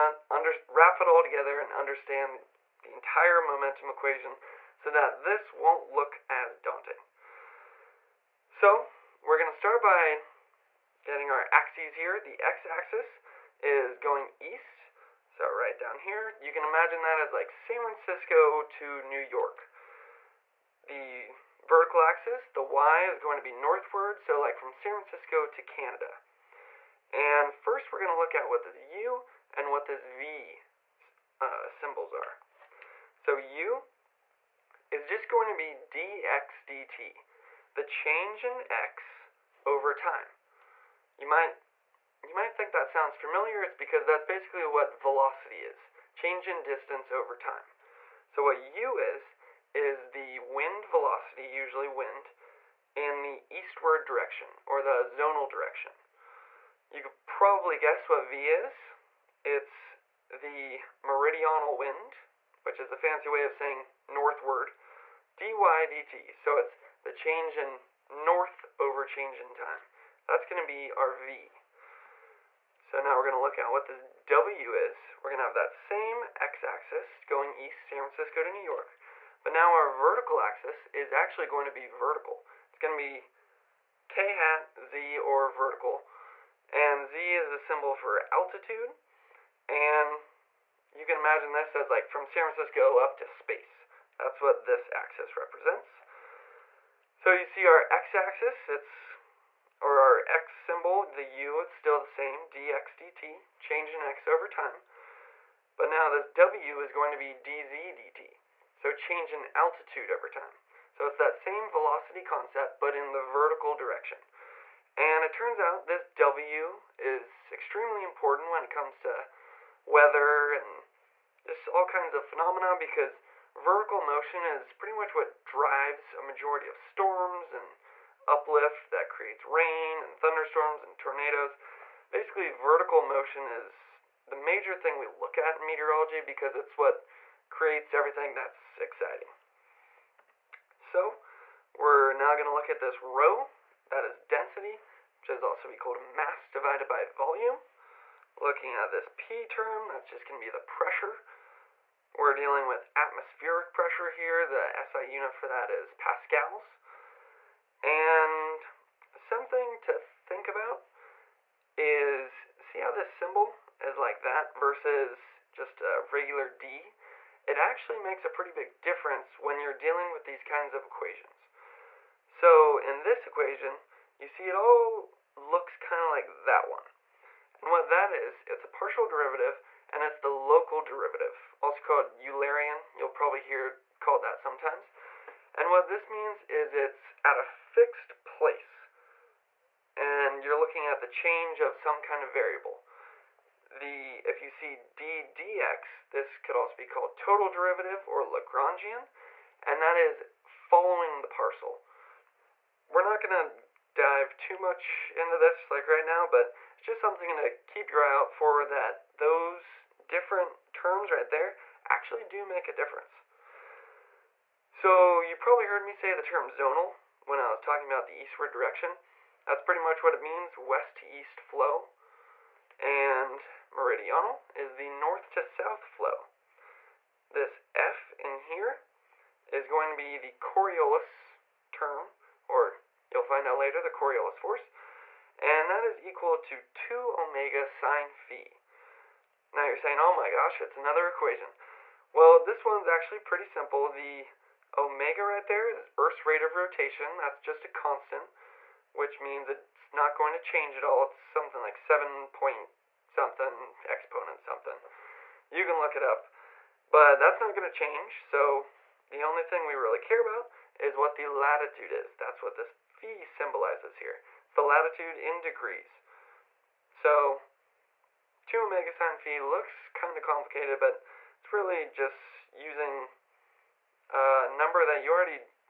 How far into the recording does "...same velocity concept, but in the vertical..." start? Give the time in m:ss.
1:51.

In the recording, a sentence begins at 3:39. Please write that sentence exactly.
That's pretty much what it means, west to east flow.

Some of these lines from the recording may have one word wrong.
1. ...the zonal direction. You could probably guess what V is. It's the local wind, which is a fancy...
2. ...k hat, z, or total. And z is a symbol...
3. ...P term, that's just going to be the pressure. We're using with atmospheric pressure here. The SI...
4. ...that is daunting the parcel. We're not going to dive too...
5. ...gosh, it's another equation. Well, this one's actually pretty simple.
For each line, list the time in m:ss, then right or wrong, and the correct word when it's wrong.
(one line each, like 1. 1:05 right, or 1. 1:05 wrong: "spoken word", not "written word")
1. 0:54 wrong: "meridional", not "local"
2. 1:24 wrong: "vertical", not "total"
3. 2:29 wrong: "dealing", not "using"
4. 3:19 wrong: "following", not "daunting"
5. 4:00 right.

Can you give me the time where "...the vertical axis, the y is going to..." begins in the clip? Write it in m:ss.
0:20.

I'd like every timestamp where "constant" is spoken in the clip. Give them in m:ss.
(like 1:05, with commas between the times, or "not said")
4:07.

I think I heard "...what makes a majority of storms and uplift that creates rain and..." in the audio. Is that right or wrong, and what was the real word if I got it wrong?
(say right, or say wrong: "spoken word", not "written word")
wrong: "drives", not "makes".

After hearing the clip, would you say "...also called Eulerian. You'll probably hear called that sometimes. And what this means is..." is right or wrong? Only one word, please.
right.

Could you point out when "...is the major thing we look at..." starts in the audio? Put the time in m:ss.
2:13.